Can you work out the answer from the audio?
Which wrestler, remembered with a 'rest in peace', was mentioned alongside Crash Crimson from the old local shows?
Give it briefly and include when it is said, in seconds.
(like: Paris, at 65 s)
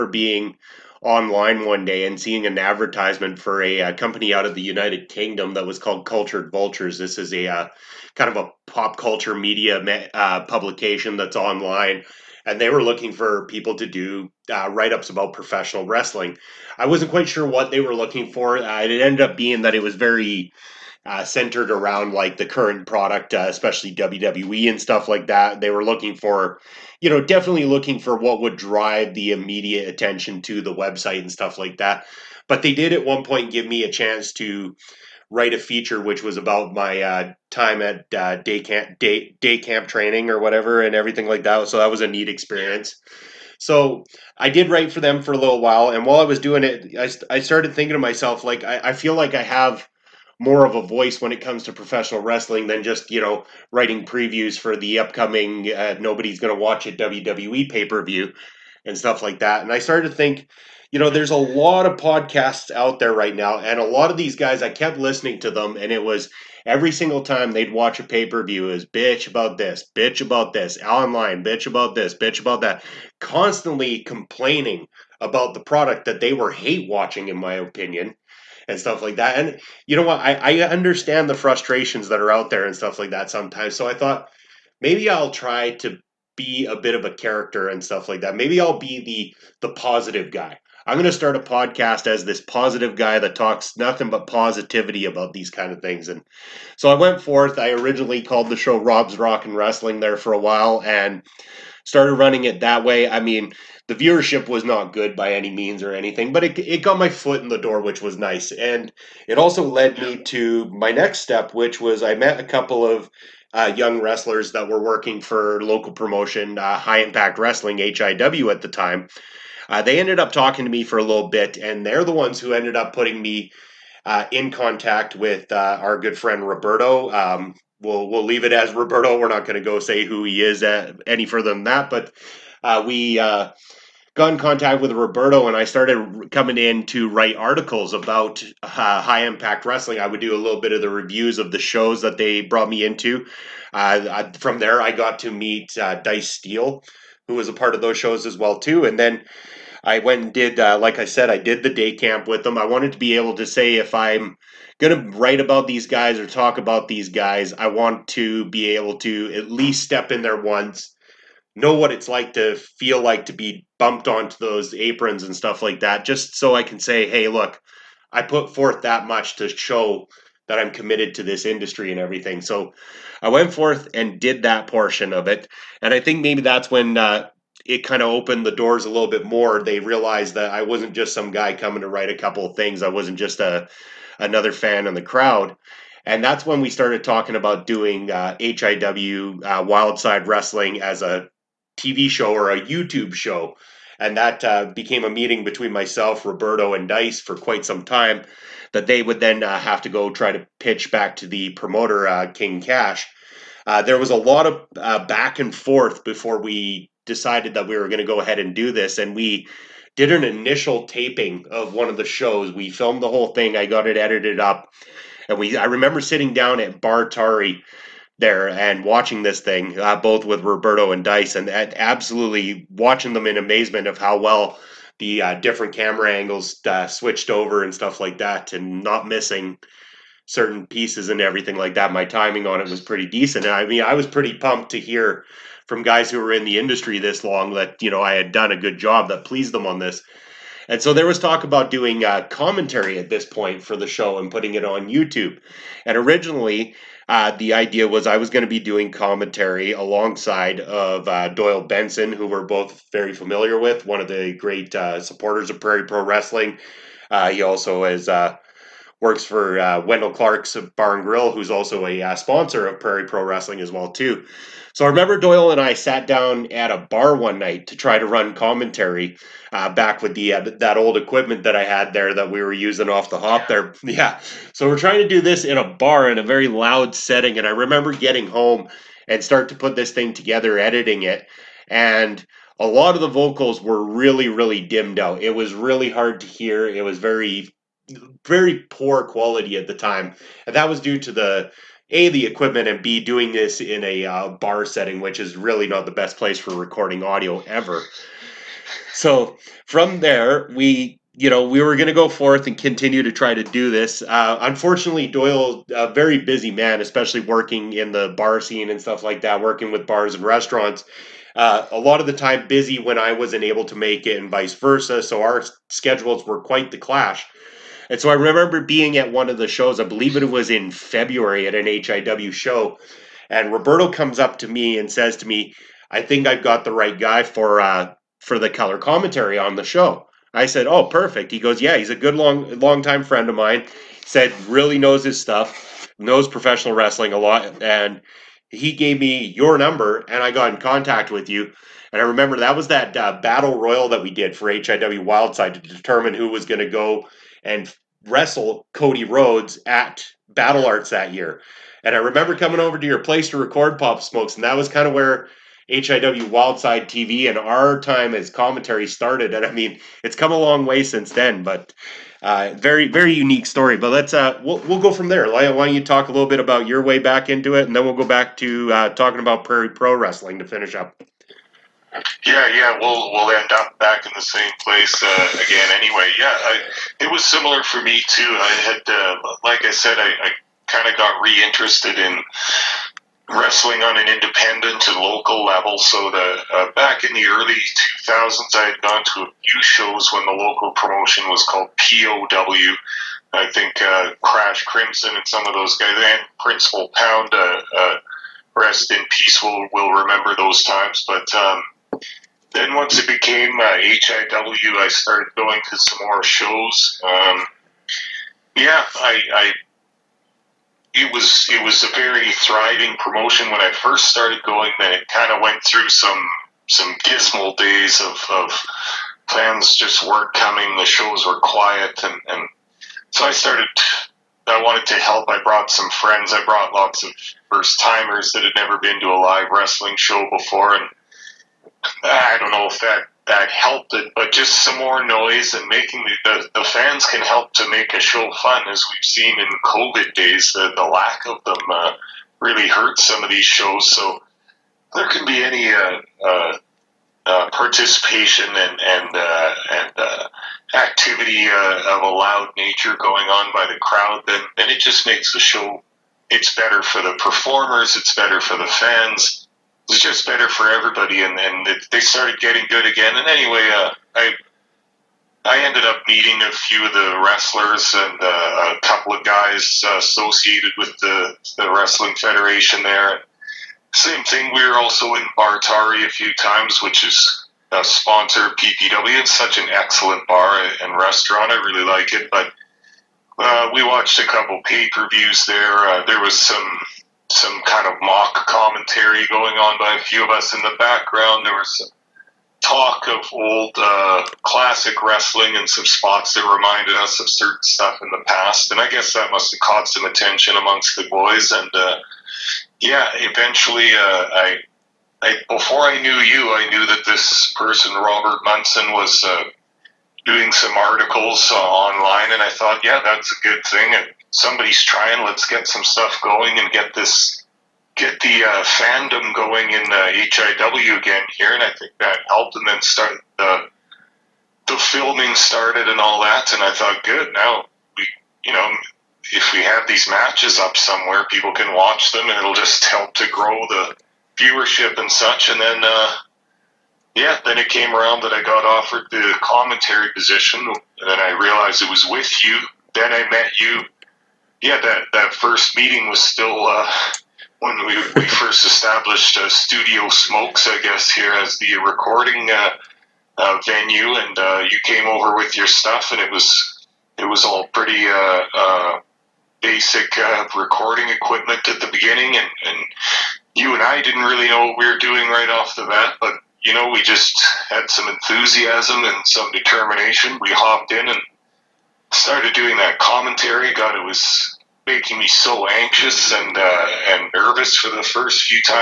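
Principal Pound, at 396 s.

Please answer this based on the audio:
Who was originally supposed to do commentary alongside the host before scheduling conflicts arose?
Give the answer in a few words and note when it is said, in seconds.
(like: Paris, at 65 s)
Doyle Benson, at 251 s.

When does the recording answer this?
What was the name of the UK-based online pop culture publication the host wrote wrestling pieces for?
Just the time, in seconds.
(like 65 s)
6 s.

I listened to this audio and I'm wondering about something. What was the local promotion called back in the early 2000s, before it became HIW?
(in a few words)
POW.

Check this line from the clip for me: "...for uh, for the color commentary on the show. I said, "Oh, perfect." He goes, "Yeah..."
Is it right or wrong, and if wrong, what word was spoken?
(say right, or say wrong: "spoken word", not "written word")
right.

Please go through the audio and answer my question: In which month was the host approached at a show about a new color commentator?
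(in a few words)
February.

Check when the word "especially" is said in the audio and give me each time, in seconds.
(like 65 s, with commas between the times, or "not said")
23 s, 306 s.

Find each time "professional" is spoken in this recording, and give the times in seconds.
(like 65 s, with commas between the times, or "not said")
15 s, 51 s, 336 s.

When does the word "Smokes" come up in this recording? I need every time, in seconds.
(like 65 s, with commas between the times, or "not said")
354 s, 550 s.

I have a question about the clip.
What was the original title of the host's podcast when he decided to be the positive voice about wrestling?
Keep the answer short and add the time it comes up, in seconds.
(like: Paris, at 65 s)
Rob's Rock and Wrestling, at 98 s.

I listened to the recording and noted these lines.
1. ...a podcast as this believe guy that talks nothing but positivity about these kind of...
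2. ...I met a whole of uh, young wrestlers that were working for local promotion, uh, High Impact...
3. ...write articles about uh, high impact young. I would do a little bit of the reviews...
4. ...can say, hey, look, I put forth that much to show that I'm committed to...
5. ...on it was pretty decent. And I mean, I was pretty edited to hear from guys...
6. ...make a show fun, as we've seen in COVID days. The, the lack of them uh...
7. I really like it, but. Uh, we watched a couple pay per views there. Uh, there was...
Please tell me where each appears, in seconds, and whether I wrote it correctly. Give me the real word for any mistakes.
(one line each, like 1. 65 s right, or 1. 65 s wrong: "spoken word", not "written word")
1. 91 s wrong: "positive", not "believe"
2. 112 s wrong: "couple", not "whole"
3. 137 s wrong: "wrestling", not "young"
4. 166 s right
5. 232 s wrong: "pumped", not "edited"
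6. 437 s right
7. 481 s right.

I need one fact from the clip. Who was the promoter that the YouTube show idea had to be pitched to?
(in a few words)
King Cash.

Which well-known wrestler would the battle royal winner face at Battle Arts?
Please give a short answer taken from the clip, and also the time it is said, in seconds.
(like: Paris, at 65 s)
Cody Rhodes, at 348 s.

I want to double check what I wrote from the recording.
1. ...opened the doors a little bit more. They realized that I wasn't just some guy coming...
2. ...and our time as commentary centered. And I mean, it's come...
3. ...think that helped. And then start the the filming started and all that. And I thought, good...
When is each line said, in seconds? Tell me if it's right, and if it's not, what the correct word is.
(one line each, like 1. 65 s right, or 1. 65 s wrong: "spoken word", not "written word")
1. 178 s right
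2. 357 s wrong: "started", not "centered"
3. 521 s right.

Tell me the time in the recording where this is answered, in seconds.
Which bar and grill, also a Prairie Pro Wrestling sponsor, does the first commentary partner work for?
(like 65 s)
259 s.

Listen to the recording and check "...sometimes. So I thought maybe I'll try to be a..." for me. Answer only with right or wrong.
right.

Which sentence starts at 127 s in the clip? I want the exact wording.
Um, we'll we'll leave it as Roberto.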